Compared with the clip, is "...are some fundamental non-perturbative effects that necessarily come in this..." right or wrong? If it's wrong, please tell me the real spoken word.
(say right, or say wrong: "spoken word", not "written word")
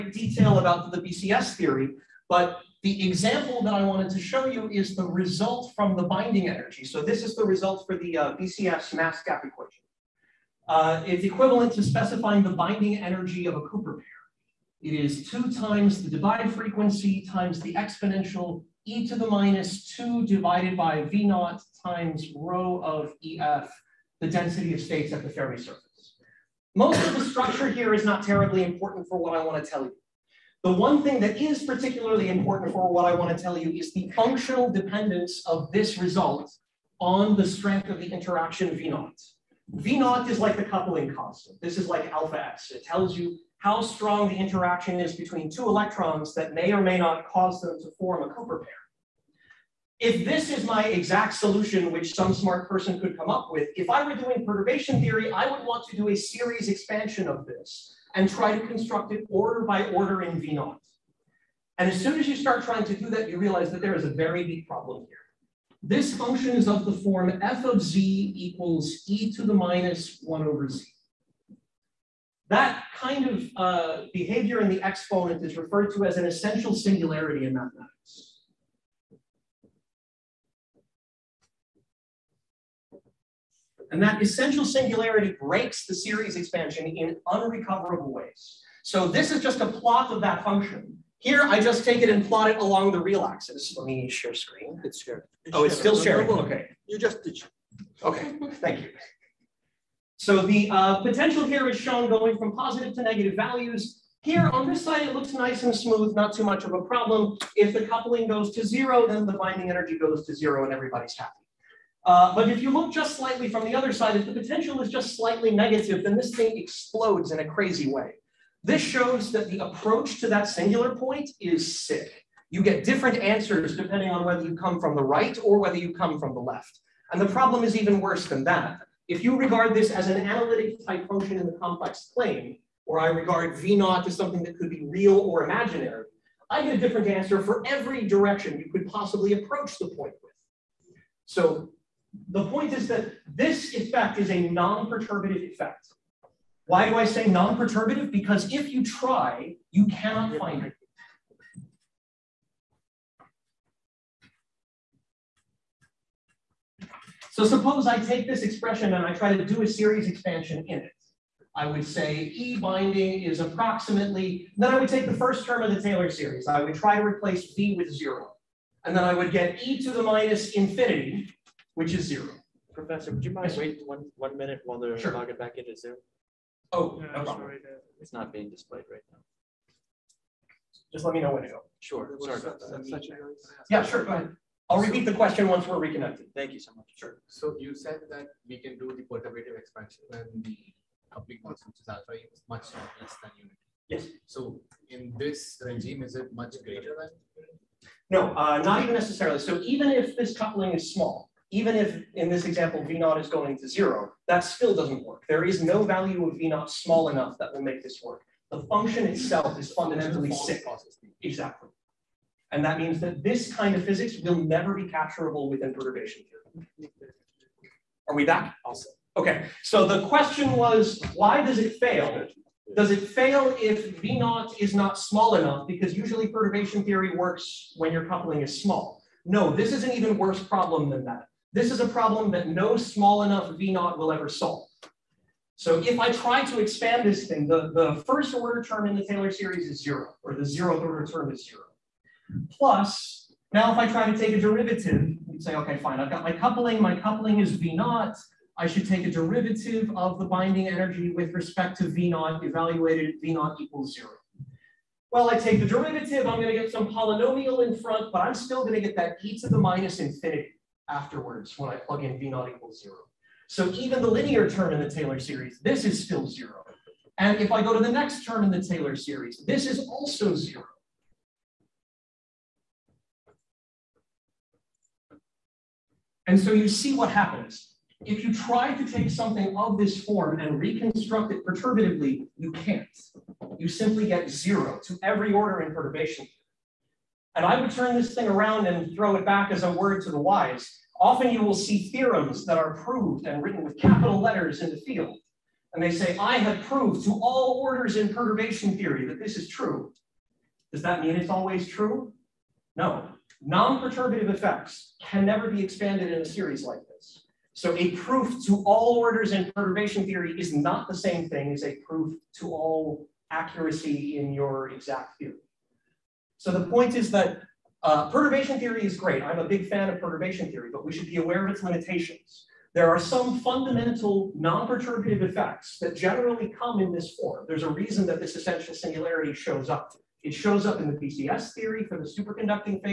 wrong: "generally", not "necessarily".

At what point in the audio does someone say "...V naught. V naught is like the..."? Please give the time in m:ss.
0:38.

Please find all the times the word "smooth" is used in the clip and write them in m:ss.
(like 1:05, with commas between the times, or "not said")
1:45.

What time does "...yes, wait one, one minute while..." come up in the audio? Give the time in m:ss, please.
2:53.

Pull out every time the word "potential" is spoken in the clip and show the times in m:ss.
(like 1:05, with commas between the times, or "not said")
1:41, 1:54.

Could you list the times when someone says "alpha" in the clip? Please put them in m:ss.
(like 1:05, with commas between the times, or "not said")
0:42, 3:11.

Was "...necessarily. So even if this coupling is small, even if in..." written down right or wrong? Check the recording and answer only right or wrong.
right.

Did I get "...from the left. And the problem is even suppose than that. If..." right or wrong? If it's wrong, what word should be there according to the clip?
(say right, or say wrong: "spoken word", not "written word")
wrong: "worse", not "suppose".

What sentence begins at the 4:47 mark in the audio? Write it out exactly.
And I would turn this thing around and throw it back as a word to the wise.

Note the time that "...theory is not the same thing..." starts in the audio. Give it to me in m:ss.
5:10.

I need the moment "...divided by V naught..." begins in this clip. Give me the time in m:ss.
0:20.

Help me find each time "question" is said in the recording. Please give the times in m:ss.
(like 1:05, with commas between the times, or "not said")
3:05, 3:40.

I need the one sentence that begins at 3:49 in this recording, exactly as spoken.
No, this is an even worse problem than that.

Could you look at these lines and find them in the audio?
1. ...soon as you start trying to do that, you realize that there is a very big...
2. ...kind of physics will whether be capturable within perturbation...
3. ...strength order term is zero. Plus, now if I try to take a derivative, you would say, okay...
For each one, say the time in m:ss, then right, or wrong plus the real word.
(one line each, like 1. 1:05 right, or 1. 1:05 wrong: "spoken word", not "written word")
1. 1:02 right
2. 3:33 wrong: "never", not "whether"
3. 4:00 wrong: "zeroth", not "strength".